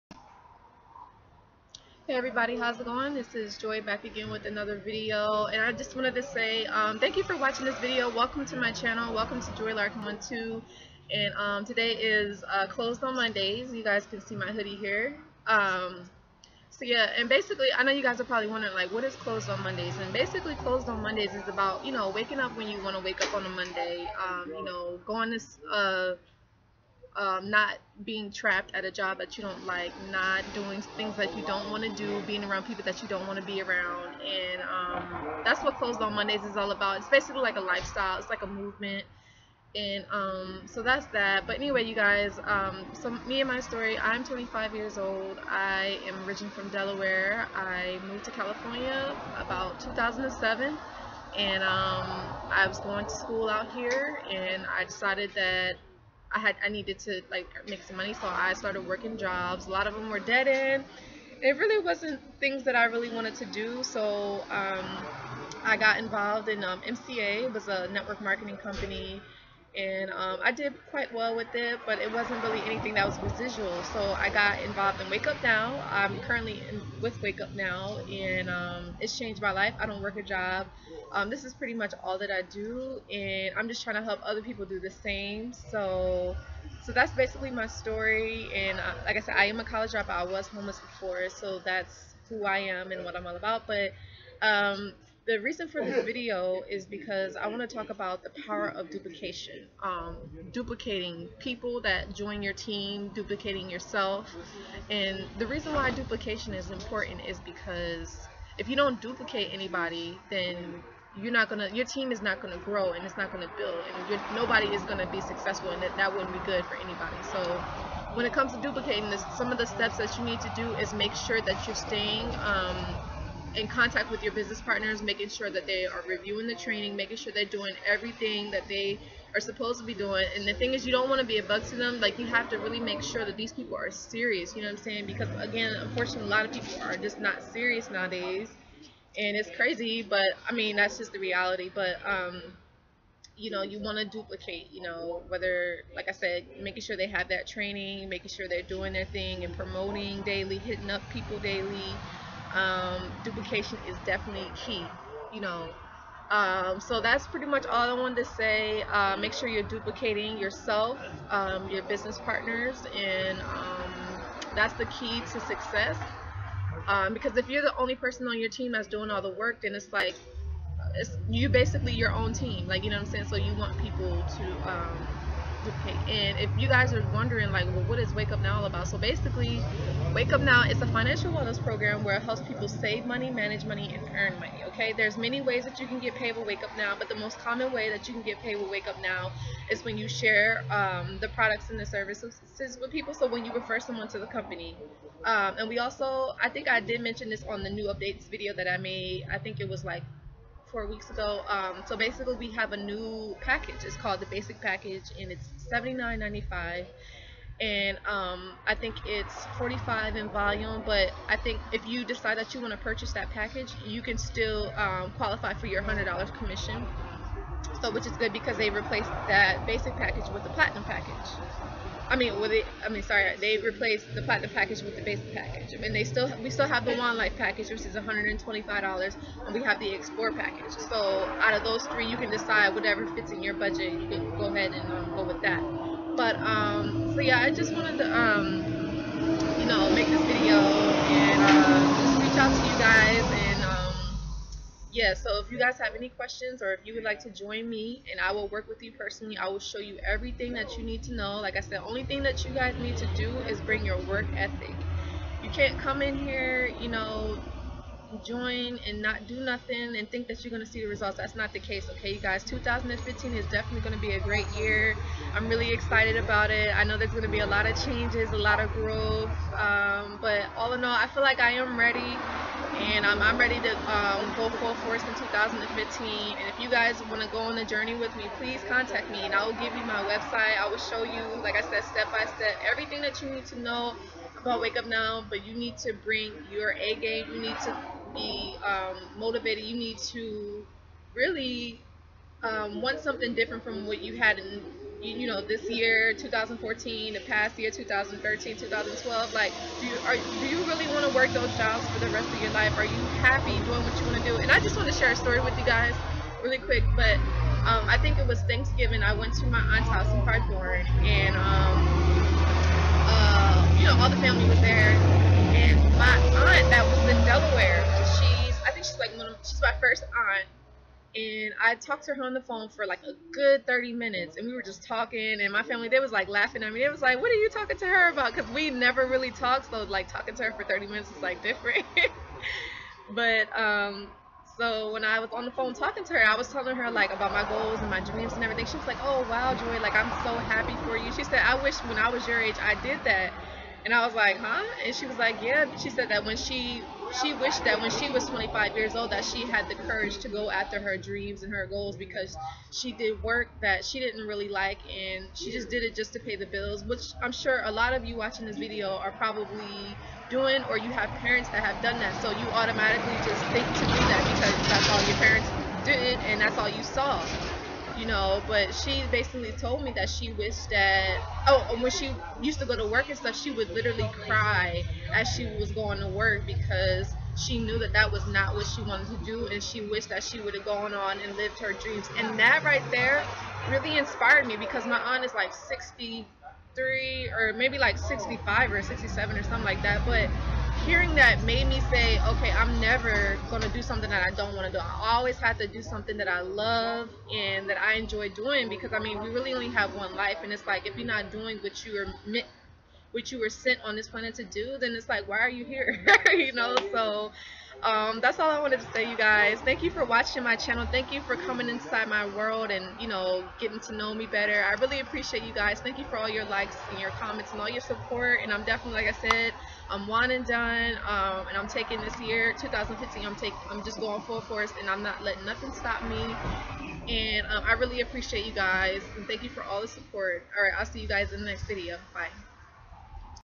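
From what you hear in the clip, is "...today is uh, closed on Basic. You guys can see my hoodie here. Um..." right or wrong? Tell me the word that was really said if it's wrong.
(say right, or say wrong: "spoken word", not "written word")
wrong: "Mondays", not "Basic".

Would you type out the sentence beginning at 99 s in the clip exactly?
Um, duplicating people that join your team, duplicating yourself.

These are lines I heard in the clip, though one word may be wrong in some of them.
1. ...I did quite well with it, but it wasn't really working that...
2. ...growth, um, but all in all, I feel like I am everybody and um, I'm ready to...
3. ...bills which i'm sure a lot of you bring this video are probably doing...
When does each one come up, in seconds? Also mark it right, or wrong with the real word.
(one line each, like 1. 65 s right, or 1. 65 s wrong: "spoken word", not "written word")
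1. 70 s wrong: "anything", not "working"
2. 268 s wrong: "ready", not "everybody"
3. 356 s wrong: "watching", not "bring".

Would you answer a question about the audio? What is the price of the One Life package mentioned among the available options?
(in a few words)
$125.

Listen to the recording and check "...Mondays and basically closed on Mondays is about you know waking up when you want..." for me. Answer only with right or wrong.
right.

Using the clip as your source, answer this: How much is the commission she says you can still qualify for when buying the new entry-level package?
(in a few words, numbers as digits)
$100.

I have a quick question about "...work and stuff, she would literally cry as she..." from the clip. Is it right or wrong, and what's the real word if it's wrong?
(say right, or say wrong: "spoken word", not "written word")
right.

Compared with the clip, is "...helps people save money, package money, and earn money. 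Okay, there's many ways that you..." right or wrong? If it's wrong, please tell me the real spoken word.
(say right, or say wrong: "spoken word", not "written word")
wrong: "manage", not "package".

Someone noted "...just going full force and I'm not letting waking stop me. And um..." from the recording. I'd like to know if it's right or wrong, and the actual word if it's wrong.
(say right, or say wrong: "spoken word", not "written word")
wrong: "nothing", not "waking".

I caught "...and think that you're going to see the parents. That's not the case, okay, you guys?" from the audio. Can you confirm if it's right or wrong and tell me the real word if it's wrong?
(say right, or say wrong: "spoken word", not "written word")
wrong: "results", not "parents".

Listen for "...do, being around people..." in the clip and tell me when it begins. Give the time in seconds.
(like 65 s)
31 s.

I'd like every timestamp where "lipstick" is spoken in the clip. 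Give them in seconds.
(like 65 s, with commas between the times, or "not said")
not said.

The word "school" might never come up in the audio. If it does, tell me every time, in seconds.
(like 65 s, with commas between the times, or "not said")
53 s.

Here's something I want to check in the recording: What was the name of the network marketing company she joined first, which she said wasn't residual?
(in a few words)
MCA.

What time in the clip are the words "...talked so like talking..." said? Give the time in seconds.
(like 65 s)
329 s.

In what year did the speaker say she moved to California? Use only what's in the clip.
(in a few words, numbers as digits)
2007.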